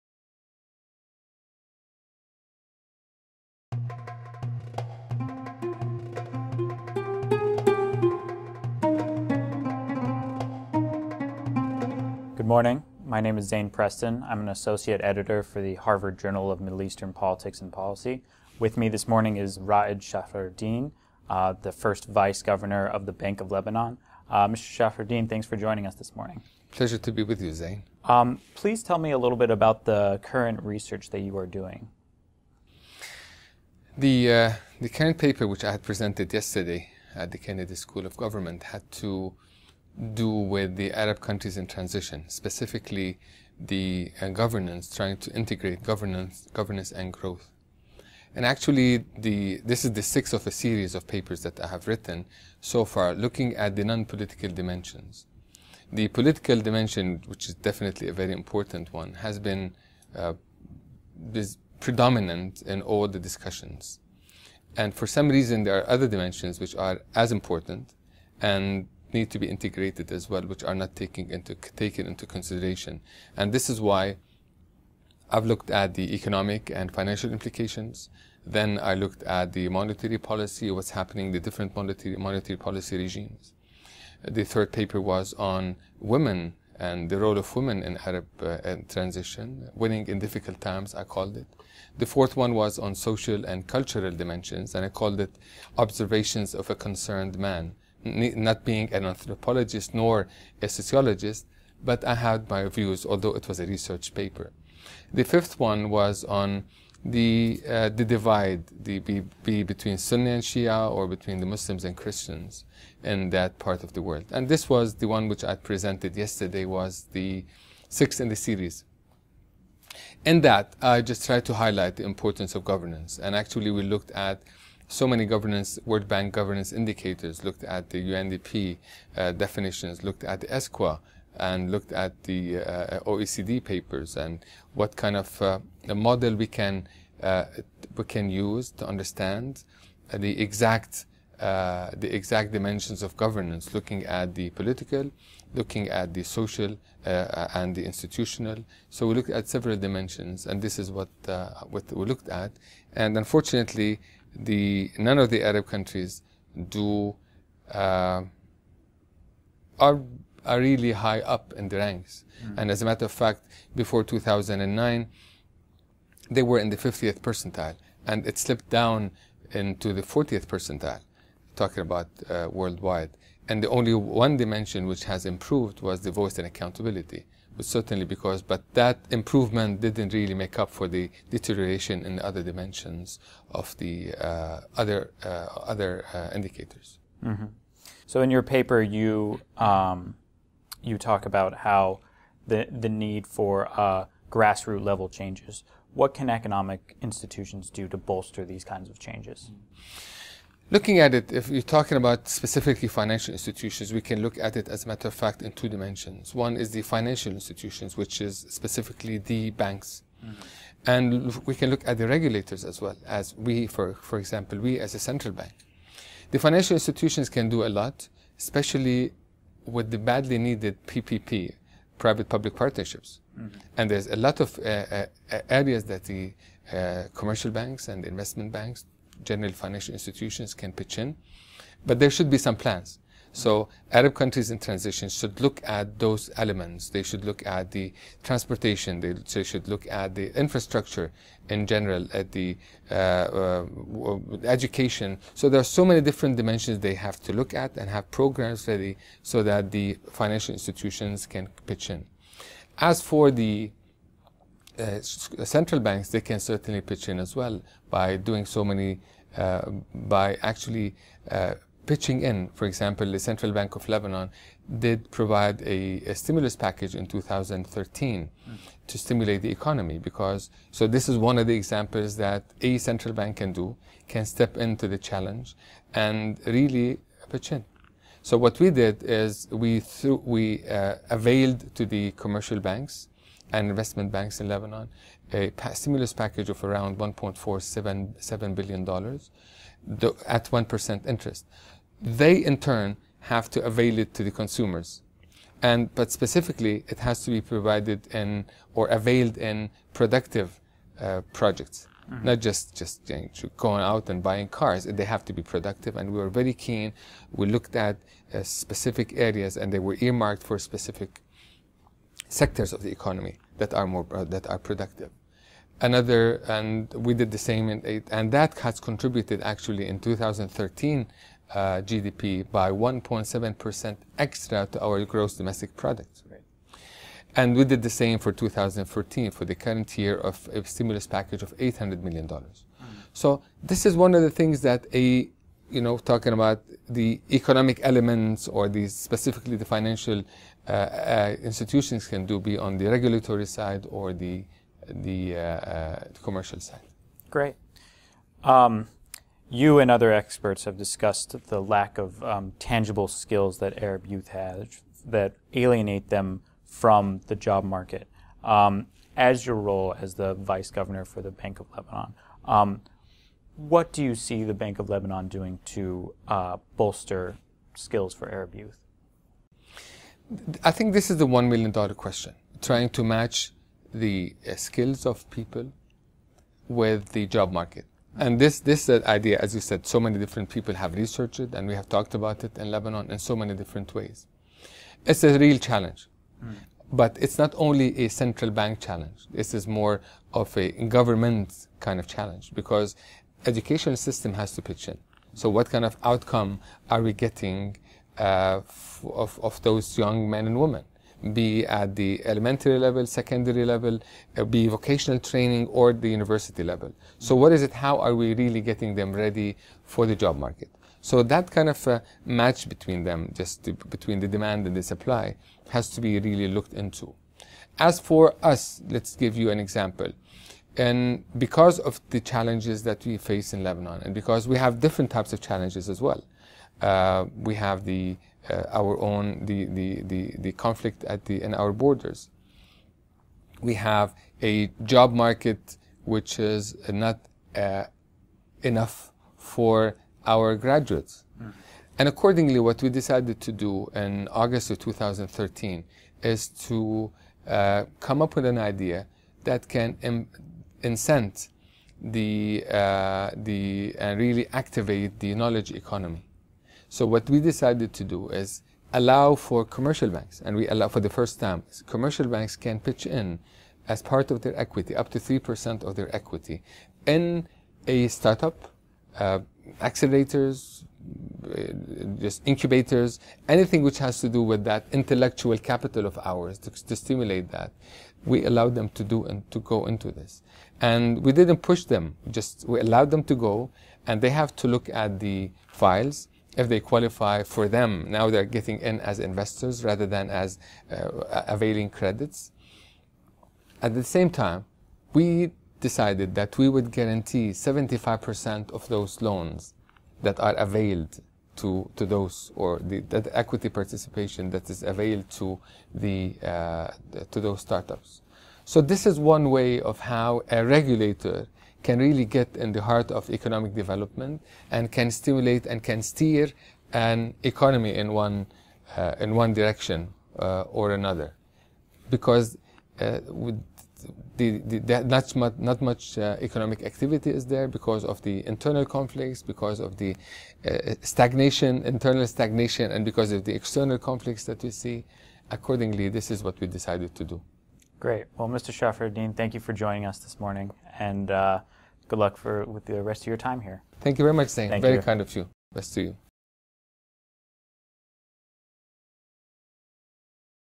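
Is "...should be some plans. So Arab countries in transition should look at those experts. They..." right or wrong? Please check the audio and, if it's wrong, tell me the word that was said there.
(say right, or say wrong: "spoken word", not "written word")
wrong: "elements", not "experts".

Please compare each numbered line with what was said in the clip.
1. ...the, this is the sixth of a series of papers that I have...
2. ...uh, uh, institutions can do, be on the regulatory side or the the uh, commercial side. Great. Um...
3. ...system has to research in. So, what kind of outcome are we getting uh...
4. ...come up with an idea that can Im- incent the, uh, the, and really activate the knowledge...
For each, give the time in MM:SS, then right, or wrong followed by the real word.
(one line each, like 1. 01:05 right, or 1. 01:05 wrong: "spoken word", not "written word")
1. 00:49 right
2. 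05:40 right
3. 06:33 wrong: "pitch", not "research"
4. 07:27 right.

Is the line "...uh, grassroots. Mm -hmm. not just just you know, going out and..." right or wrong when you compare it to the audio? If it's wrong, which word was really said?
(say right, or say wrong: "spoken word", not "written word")
wrong: "projects", not "grassroots".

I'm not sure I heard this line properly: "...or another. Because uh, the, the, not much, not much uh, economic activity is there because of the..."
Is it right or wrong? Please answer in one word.
right.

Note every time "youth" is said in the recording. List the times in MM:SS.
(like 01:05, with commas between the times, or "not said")
05:54, 06:08.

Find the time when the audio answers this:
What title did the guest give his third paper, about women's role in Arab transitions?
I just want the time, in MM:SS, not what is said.
01:29.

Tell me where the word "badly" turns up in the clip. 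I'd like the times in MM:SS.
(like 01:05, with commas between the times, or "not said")
03:39.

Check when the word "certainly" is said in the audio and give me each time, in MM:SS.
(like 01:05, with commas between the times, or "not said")
02:57, 04:16.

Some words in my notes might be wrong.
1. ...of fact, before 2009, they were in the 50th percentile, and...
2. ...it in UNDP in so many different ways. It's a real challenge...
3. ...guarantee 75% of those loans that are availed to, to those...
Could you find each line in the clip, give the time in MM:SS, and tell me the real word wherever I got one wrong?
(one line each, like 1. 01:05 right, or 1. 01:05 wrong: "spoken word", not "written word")
1. 02:43 right
2. 06:22 wrong: "Lebanon", not "UNDP"
3. 08:16 right.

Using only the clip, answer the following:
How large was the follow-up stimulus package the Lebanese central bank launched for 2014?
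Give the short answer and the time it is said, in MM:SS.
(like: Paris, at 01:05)
800 million dollars, at 05:31.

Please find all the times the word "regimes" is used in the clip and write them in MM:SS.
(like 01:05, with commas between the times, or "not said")
01:22.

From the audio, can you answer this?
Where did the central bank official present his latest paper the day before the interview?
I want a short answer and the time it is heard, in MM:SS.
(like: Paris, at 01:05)
Kennedy School of Government, at 00:37.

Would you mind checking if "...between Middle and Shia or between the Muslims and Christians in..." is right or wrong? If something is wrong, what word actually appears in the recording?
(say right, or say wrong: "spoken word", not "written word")
wrong: "Sunni", not "Middle".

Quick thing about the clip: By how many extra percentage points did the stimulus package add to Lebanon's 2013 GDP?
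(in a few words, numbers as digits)
1.7 percent.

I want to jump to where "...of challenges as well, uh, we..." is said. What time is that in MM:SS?
07:05.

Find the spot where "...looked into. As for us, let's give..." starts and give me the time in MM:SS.
06:56.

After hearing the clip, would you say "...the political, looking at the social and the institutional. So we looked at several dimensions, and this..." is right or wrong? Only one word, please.
right.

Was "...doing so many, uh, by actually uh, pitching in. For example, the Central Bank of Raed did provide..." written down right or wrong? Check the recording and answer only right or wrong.
wrong.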